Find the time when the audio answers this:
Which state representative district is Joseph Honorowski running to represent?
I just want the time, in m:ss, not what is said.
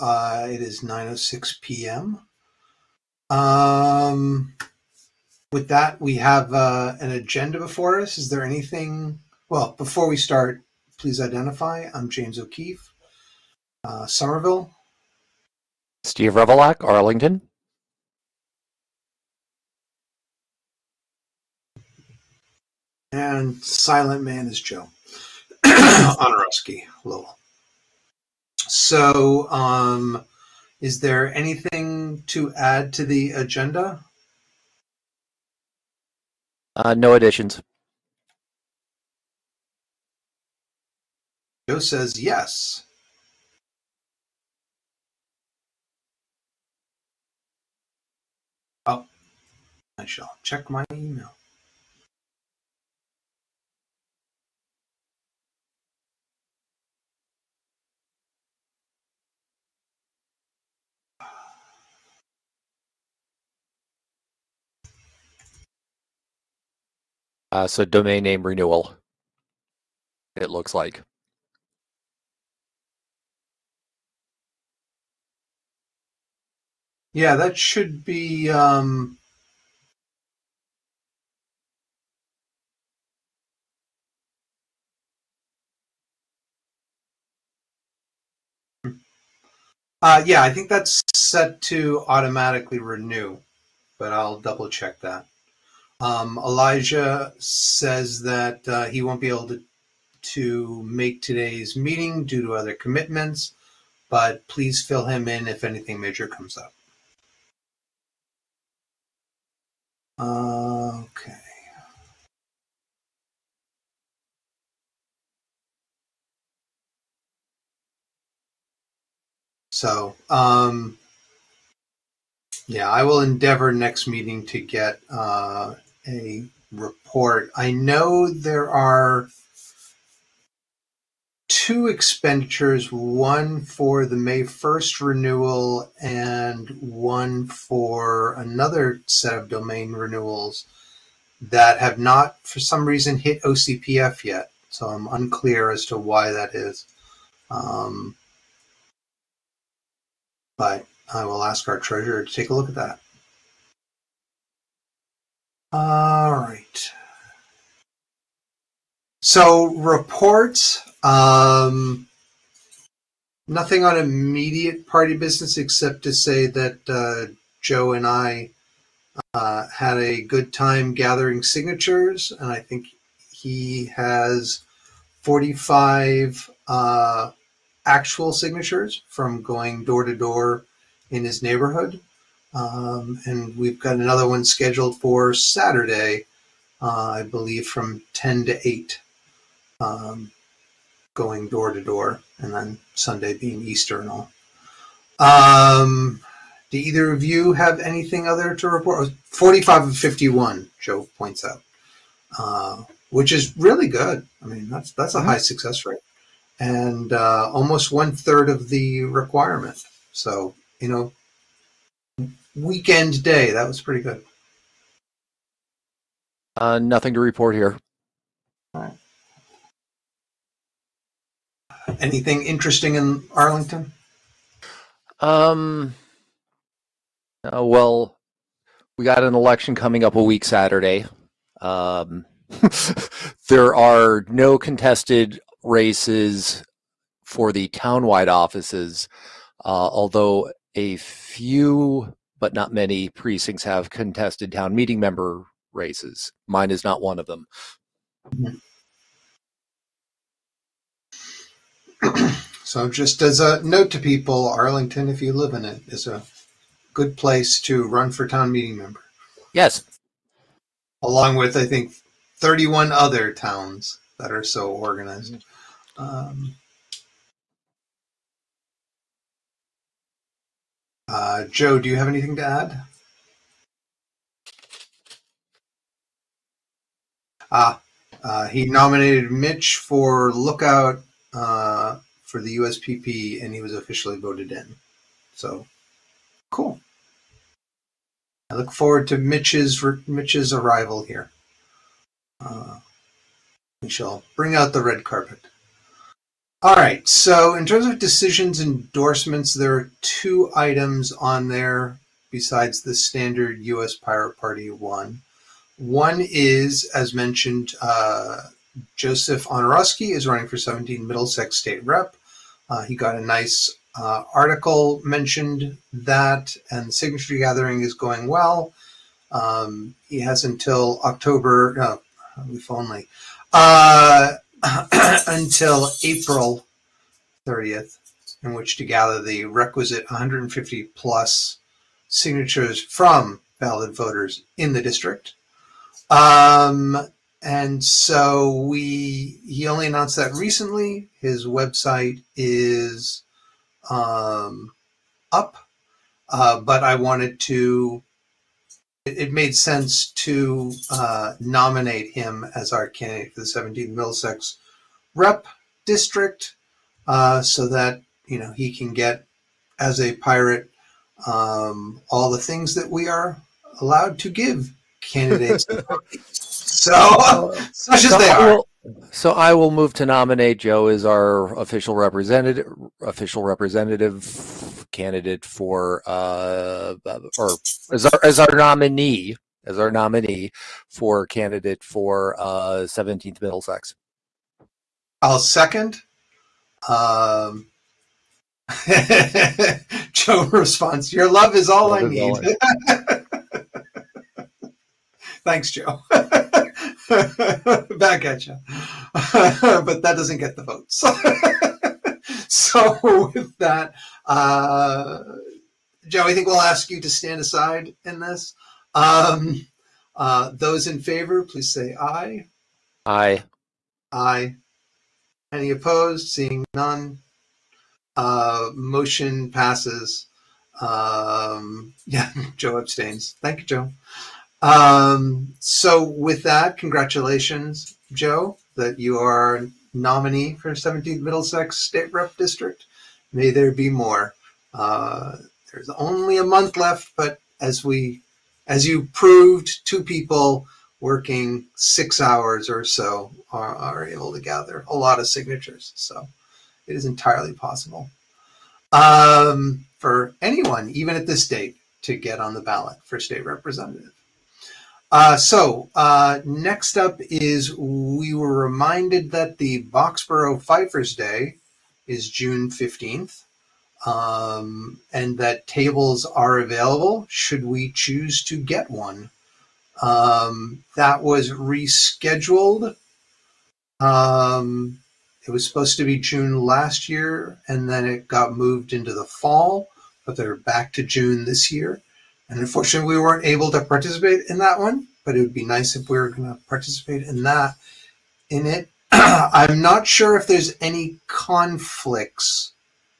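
5:10.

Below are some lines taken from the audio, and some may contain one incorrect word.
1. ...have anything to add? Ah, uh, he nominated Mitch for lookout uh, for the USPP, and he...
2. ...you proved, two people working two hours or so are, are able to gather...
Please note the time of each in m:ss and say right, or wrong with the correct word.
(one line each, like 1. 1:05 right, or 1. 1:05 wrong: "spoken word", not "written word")
1. 4:31 right
2. 7:18 wrong: "six", not "two".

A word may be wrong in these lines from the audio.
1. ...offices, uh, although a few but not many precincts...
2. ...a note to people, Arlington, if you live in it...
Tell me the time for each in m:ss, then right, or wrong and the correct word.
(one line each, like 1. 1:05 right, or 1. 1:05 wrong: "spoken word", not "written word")
1. 3:58 right
2. 4:13 right.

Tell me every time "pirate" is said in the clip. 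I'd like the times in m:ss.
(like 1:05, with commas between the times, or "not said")
5:03, 6:00.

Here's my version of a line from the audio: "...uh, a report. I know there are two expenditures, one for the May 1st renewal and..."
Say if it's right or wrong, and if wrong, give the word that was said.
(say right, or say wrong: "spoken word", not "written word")
right.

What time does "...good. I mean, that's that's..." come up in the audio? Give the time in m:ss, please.
3:23.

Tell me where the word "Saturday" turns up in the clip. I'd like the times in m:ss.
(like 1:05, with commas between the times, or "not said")
3:05, 3:50.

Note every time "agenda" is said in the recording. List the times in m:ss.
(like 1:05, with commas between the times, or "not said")
0:07, 0:33.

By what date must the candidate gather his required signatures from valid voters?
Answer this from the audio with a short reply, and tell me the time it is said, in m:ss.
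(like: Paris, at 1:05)
April 30th, at 5:26.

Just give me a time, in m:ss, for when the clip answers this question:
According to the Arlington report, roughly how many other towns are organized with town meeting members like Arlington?
4:22.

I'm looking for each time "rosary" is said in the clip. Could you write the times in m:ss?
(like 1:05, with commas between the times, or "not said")
not said.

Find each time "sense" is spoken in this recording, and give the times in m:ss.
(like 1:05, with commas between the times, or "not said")
5:49.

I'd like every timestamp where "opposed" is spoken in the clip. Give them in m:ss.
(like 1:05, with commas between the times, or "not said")
6:55.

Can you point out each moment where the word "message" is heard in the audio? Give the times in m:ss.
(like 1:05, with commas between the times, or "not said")
not said.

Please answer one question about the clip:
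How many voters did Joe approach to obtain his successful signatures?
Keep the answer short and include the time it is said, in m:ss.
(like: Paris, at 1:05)
51, at 3:19.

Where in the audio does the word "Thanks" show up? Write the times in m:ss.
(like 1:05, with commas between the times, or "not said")
6:35, 7:03.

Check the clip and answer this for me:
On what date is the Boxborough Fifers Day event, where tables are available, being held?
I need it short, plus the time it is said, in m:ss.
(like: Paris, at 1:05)
June 15th, at 7:42.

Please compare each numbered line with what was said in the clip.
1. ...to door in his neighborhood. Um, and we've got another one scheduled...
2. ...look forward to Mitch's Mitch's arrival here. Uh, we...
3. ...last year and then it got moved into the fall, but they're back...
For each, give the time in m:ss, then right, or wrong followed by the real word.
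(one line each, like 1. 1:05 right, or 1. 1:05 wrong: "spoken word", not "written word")
1. 3:00 right
2. 4:48 right
3. 7:56 right.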